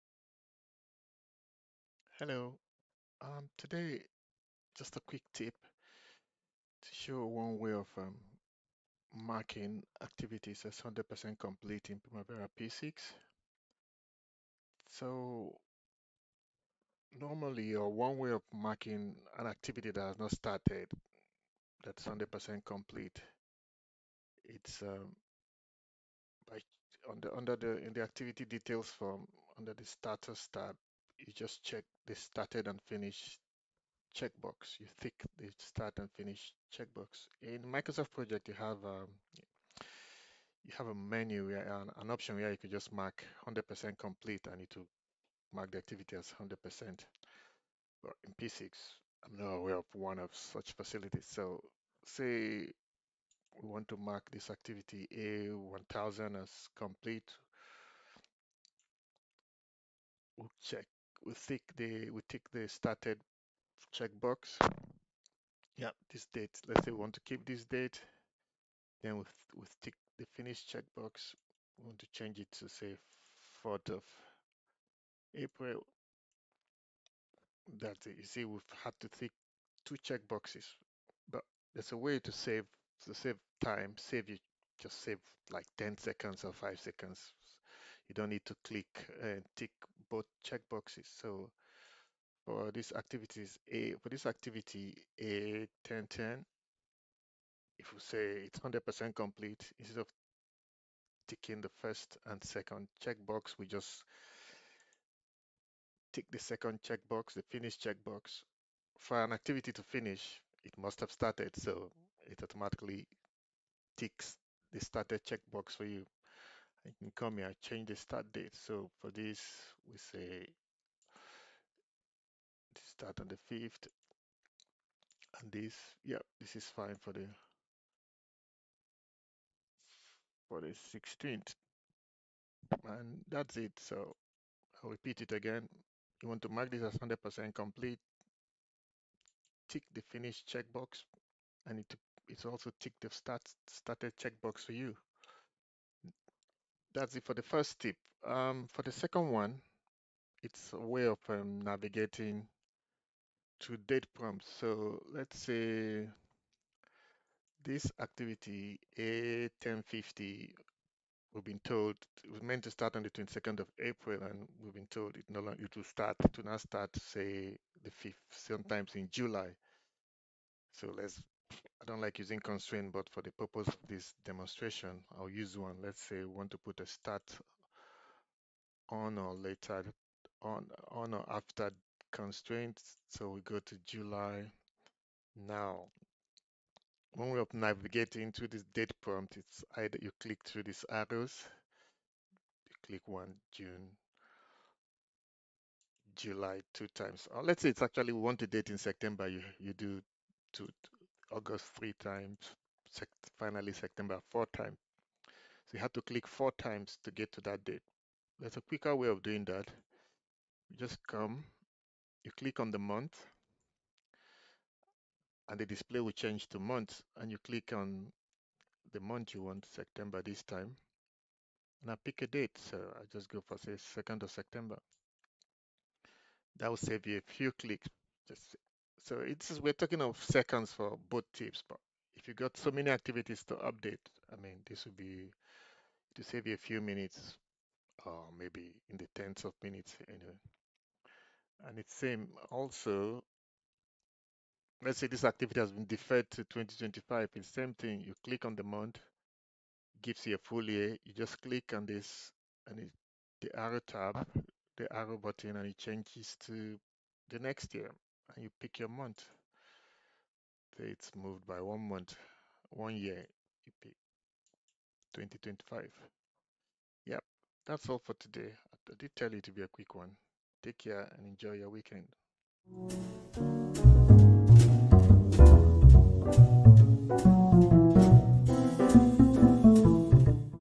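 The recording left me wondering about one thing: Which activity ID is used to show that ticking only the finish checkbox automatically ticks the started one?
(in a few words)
A1010.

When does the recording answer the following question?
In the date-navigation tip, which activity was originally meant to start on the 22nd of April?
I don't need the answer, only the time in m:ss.
2:38.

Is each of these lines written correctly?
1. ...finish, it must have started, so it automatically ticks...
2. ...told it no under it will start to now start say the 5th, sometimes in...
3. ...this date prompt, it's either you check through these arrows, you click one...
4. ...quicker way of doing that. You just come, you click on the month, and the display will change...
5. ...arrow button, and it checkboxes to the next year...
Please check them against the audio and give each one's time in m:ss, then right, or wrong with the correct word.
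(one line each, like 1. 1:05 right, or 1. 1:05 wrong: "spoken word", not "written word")
1. 1:49 right
2. 2:44 wrong: "longer", not "under"
3. 3:08 wrong: "click", not "check"
4. 3:28 right
5. 4:14 wrong: "changes", not "checkboxes".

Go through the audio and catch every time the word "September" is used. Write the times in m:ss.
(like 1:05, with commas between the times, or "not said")
3:18, 3:23, 3:39, 3:44.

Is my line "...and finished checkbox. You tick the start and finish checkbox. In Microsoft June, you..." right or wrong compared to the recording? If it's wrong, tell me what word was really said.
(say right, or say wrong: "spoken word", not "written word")
wrong: "Project", not "June".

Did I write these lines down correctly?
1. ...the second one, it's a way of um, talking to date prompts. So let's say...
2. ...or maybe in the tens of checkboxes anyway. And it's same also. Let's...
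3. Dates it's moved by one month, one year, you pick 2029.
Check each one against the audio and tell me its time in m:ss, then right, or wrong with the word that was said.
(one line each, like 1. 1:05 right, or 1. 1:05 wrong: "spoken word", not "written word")
1. 2:28 wrong: "navigating", not "talking"
2. 3:58 wrong: "minutes", not "checkboxes"
3. 4:20 wrong: "2025", not "2029".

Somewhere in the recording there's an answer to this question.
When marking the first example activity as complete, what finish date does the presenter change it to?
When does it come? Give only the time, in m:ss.
1:13.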